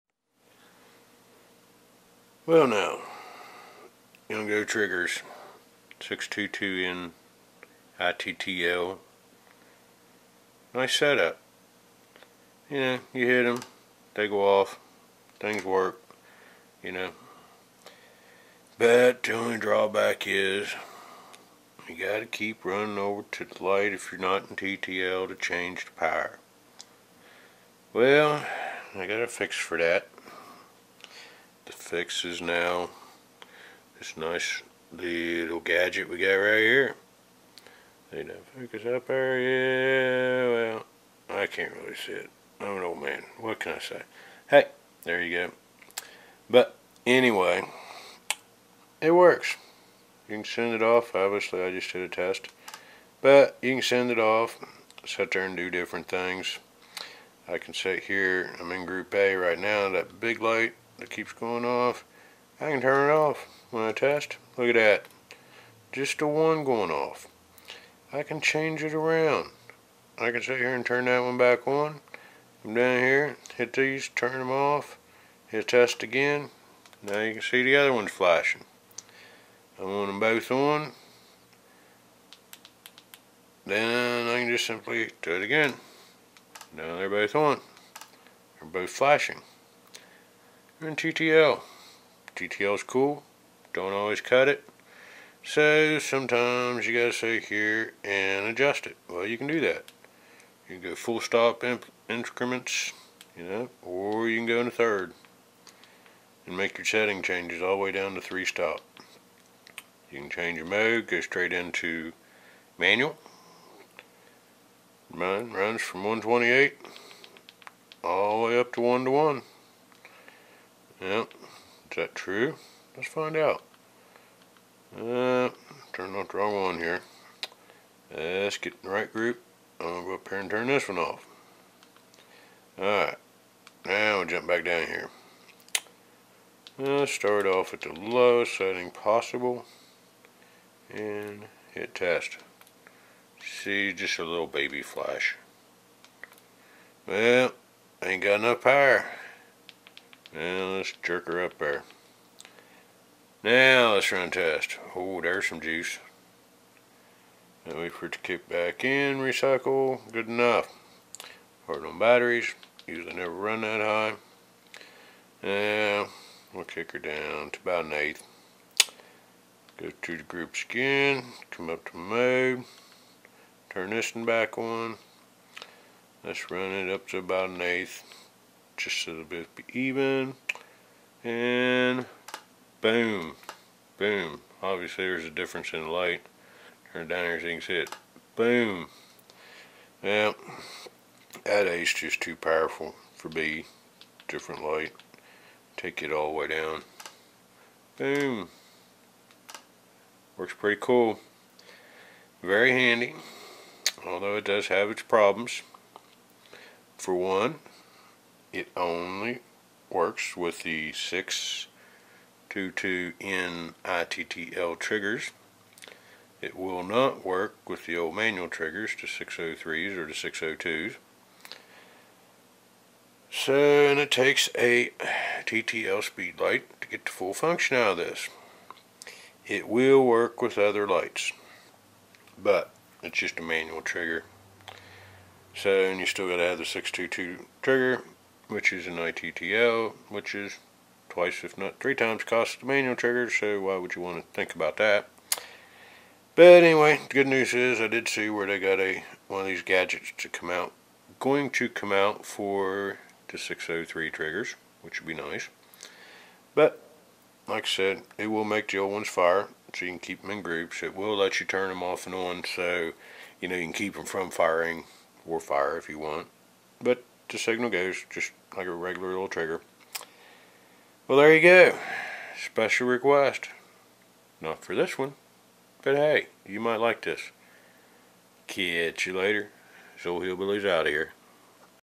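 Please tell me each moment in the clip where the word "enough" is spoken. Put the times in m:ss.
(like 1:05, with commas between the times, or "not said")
2:28, 2:40.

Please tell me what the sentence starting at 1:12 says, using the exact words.
Come down here, hit these, turn them off, hit test again.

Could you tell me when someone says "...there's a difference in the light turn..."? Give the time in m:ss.
3:05.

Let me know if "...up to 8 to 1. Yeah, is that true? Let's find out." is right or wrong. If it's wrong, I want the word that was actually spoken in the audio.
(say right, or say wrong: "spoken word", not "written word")
wrong: "1", not "8".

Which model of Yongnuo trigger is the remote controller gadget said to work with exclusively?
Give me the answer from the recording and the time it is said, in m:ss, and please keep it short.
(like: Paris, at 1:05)
622N, at 3:30.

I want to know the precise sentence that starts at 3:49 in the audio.
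It will work with other lights, but it's just a manual trigger.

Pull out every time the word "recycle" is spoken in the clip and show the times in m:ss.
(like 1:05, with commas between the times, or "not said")
2:39.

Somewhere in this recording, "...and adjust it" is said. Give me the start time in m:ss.
1:38.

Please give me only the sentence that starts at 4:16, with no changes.
But like I said, it will make the old ones fire, so you can keep them in groups.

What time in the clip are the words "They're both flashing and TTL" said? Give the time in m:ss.
1:28.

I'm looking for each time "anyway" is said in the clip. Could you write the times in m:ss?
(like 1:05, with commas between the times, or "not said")
0:47, 4:06.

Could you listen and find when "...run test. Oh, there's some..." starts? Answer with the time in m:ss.
2:34.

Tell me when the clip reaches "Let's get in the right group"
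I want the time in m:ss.
2:08.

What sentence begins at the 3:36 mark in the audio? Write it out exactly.
It will not work with the old manual triggers, to 603s or the 602s.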